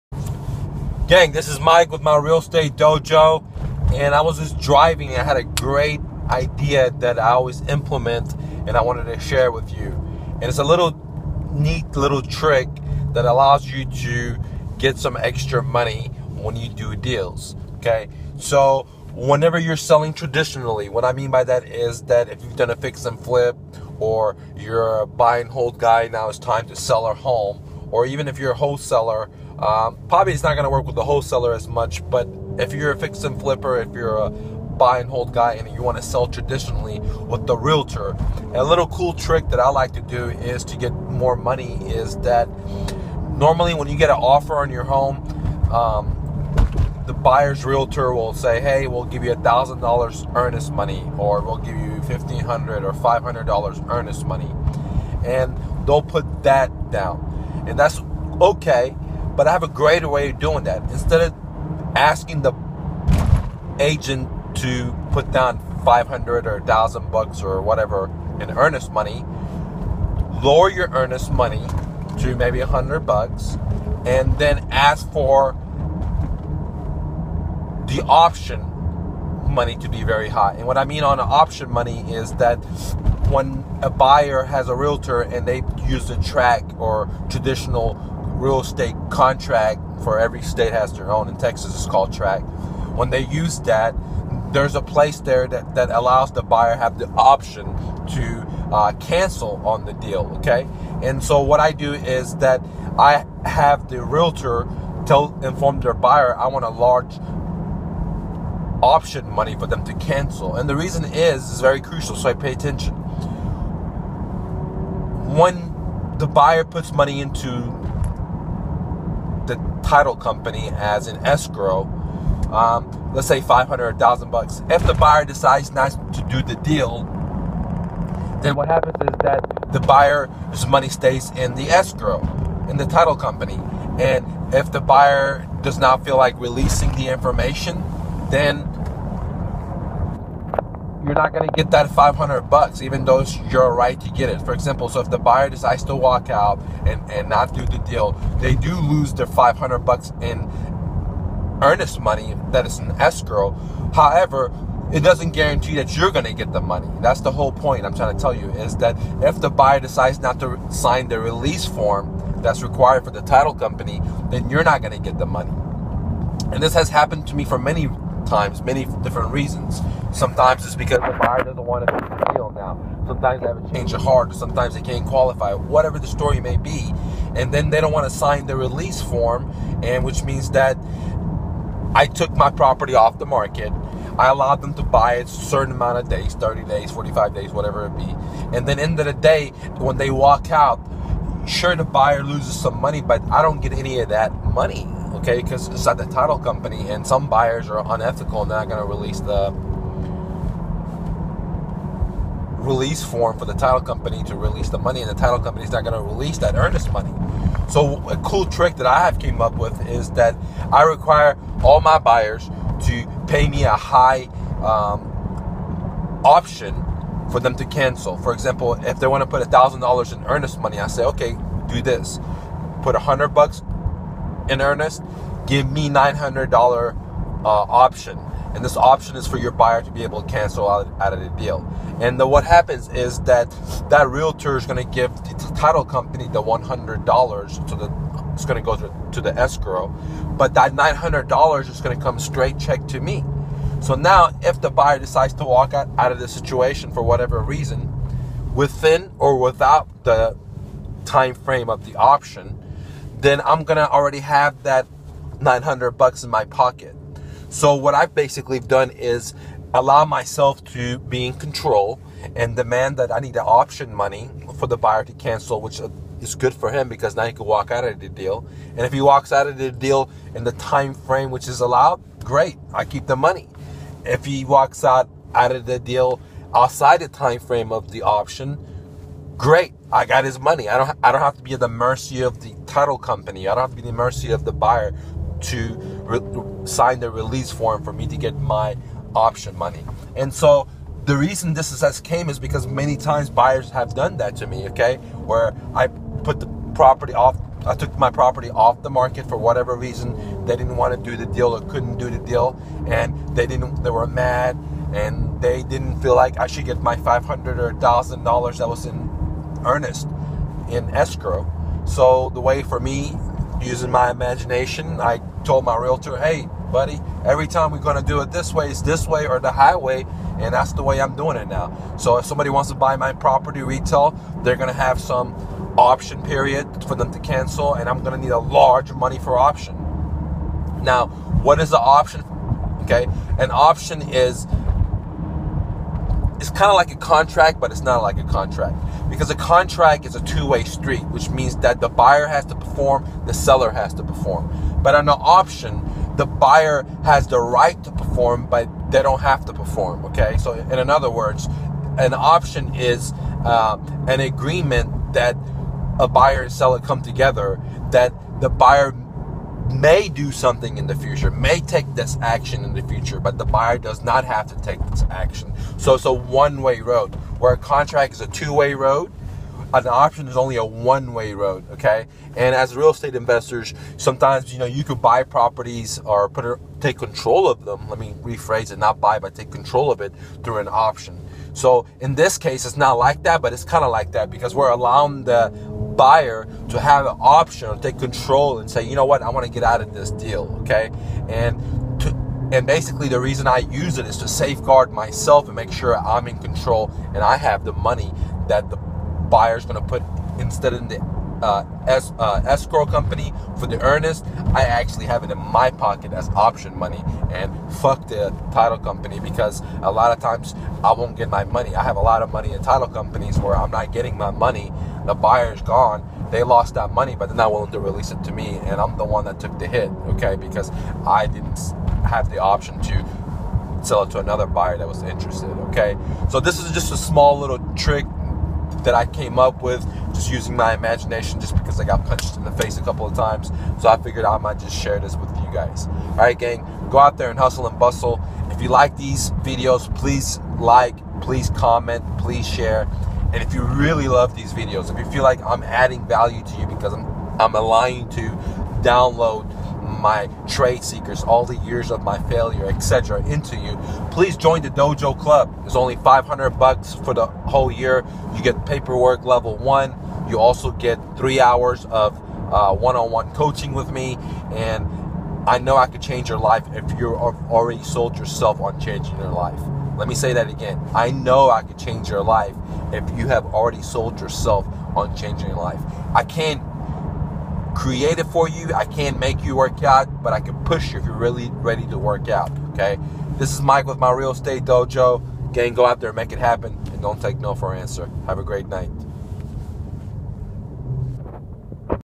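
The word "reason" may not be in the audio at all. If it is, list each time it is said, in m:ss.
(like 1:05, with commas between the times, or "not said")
1:50, 2:49, 4:07, 4:51, 4:59, 6:33.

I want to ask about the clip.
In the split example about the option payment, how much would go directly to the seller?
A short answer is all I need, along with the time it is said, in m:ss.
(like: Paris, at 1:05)
$900, at 3:45.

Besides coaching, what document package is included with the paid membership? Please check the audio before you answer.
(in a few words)
paperwork level one.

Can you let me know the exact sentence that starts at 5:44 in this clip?
But on the option, the buyer has the right to perform, but they don't have to perform.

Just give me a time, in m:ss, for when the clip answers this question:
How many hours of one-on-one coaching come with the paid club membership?
7:41.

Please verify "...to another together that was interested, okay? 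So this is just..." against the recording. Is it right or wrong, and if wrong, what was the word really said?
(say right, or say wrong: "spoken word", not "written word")
wrong: "buyer", not "together".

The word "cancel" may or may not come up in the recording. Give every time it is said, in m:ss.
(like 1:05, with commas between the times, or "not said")
1:38, 1:49, 3:37, 3:50, 4:25, 5:27.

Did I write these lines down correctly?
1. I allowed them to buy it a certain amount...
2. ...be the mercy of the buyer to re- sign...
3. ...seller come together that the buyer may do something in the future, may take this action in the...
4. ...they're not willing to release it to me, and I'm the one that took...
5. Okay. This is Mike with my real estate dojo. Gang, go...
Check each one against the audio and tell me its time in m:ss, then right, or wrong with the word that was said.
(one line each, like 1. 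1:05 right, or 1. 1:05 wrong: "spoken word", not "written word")
1. 3:04 right
2. 4:43 right
3. 5:56 right
4. 6:57 right
5. 8:02 right.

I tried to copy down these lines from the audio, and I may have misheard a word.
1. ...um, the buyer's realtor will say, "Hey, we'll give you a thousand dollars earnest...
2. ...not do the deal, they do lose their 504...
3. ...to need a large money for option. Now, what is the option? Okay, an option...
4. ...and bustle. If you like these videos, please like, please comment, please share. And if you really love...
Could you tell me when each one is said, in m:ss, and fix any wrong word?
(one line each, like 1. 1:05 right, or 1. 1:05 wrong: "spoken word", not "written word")
1. 0:45 right
2. 2:27 wrong: "500", not "504"
3. 5:28 right
4. 7:17 right.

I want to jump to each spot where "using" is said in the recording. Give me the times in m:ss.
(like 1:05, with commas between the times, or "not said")
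5:13, 7:10.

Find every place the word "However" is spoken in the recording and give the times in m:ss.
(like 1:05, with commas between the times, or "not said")
2:33.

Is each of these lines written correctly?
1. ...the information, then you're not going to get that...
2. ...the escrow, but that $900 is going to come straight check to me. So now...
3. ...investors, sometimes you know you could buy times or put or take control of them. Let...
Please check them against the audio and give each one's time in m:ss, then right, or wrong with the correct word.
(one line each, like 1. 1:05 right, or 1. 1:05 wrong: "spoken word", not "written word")
1. 2:16 right
2. 3:59 right
3. 6:13 wrong: "properties", not "times".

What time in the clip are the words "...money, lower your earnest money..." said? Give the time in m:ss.
1:08.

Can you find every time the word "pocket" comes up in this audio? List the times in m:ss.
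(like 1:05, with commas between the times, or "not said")
4:16, 6:45.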